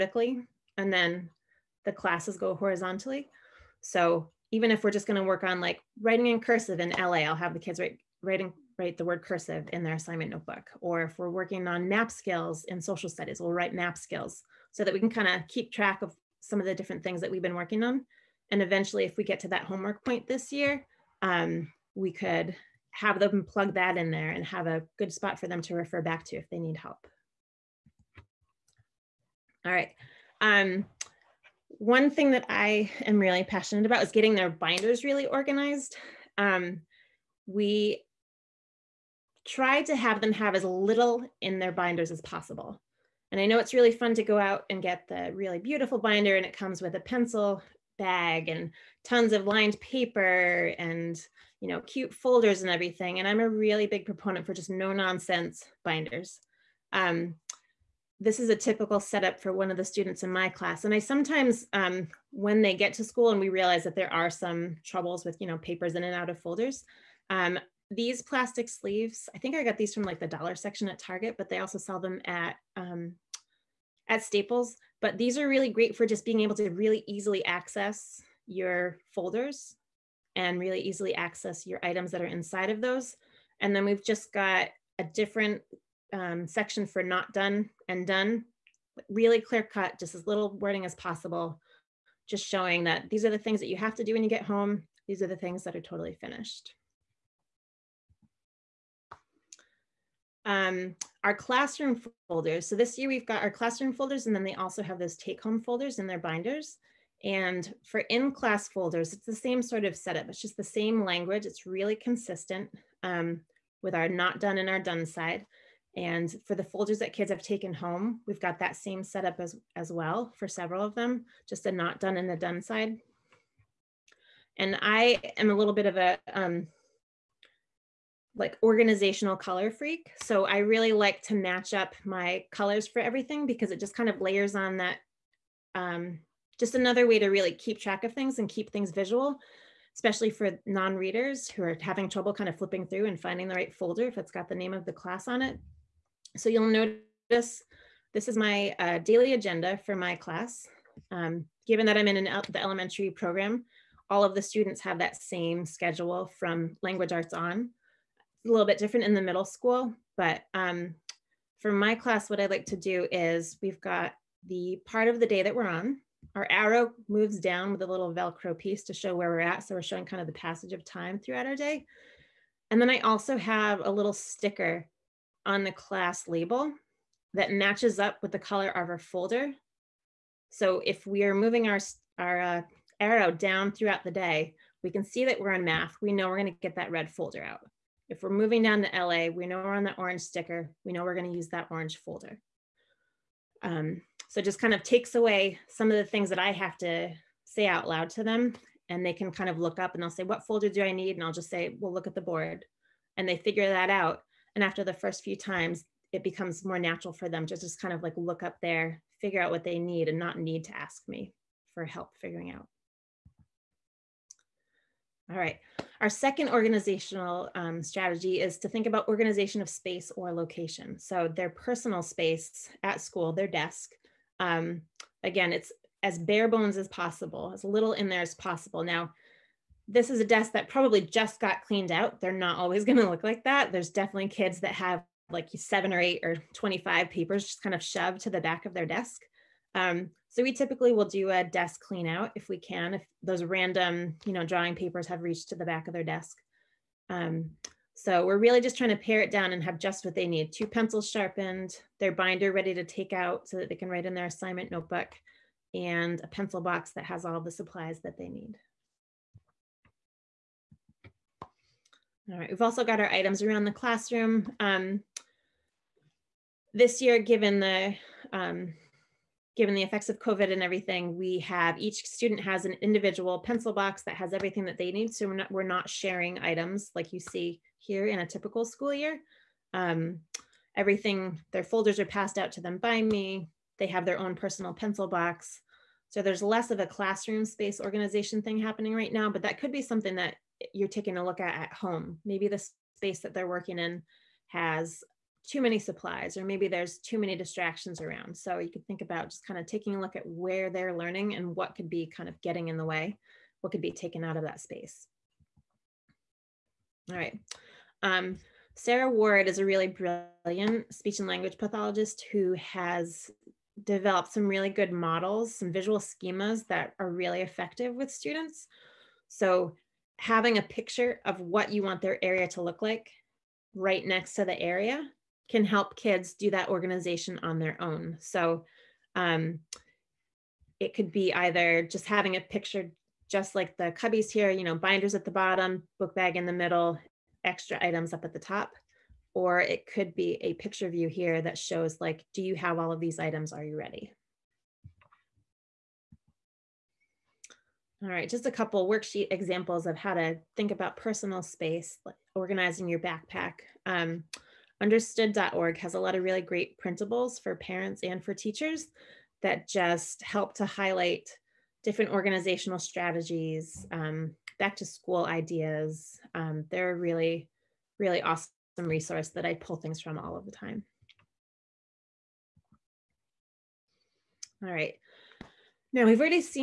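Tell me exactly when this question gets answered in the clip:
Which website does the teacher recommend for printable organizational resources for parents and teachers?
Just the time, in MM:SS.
05:54.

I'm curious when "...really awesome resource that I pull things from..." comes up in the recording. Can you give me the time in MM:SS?
06:07.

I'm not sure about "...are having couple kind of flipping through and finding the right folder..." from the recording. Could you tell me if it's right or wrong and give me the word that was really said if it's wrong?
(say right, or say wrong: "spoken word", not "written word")
wrong: "trouble", not "couple".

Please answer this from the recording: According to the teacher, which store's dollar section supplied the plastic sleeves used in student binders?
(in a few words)
Target.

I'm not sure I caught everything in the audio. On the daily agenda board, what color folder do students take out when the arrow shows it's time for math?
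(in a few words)
red.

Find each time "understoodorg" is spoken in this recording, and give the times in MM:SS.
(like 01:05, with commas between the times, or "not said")
05:54.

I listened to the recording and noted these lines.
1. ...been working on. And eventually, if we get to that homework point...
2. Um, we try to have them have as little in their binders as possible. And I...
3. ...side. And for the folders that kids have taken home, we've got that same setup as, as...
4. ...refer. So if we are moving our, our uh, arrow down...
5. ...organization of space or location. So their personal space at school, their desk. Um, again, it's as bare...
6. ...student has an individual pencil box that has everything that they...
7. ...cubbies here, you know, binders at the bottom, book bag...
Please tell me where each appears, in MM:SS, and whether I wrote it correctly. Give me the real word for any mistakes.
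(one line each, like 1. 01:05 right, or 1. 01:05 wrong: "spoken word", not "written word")
1. 00:17 right
2. 00:36 right
3. 01:55 right
4. 02:58 wrong: "folder", not "refer"
5. 03:39 right
6. 04:32 right
7. 05:33 right.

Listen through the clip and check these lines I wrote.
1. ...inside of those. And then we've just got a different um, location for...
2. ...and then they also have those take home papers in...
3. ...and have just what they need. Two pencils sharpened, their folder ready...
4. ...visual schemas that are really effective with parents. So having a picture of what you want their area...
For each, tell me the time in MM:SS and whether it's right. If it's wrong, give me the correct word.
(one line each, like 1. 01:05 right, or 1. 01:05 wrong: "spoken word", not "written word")
1. 01:22 wrong: "section", not "location"
2. 01:44 wrong: "folders", not "papers"
3. 04:09 wrong: "binder", not "folder"
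4. 05:15 wrong: "students", not "parents".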